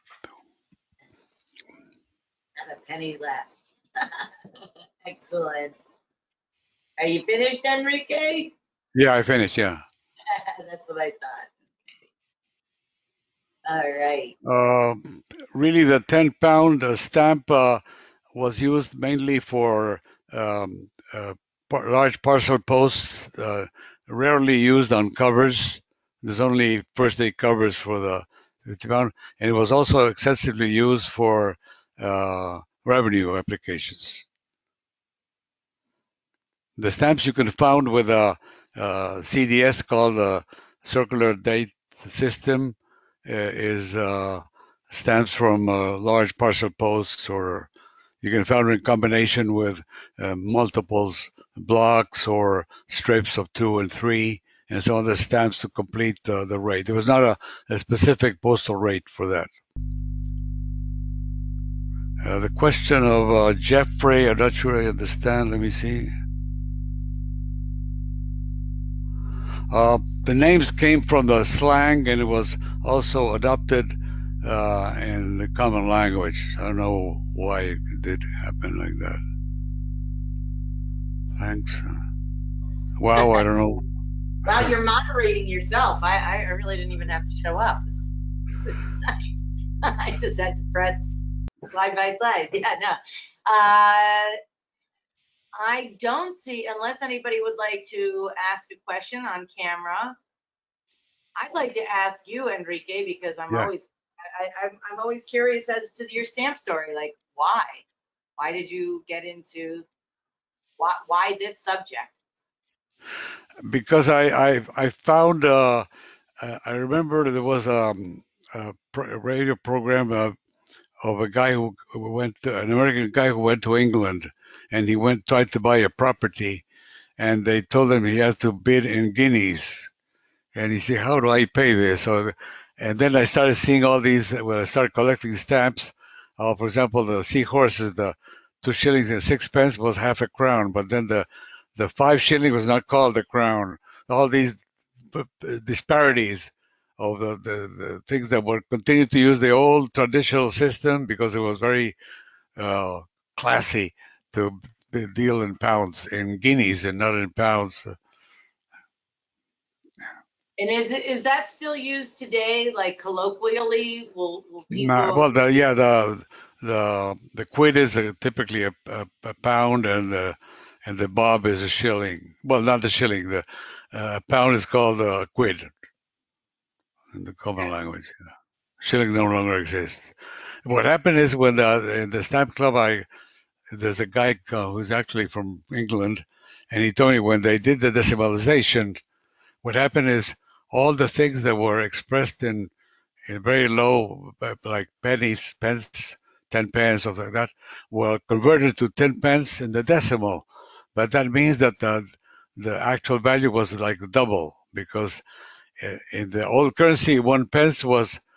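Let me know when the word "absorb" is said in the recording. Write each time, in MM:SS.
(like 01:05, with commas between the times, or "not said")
not said.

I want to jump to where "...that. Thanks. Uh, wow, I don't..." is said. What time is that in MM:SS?
01:18.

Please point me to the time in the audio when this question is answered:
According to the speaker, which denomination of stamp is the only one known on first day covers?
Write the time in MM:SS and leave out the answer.
00:28.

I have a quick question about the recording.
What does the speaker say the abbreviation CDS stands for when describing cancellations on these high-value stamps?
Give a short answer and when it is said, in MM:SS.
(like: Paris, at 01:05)
circular date system, at 00:40.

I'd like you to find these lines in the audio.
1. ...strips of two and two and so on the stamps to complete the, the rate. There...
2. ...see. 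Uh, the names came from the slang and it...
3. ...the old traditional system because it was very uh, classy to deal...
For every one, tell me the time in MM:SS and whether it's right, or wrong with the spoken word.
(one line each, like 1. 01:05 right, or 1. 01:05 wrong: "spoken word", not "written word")
1. 00:52 wrong: "three", not "two"
2. 01:05 right
3. 02:29 right.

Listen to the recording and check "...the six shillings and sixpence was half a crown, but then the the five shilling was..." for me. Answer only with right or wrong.
wrong.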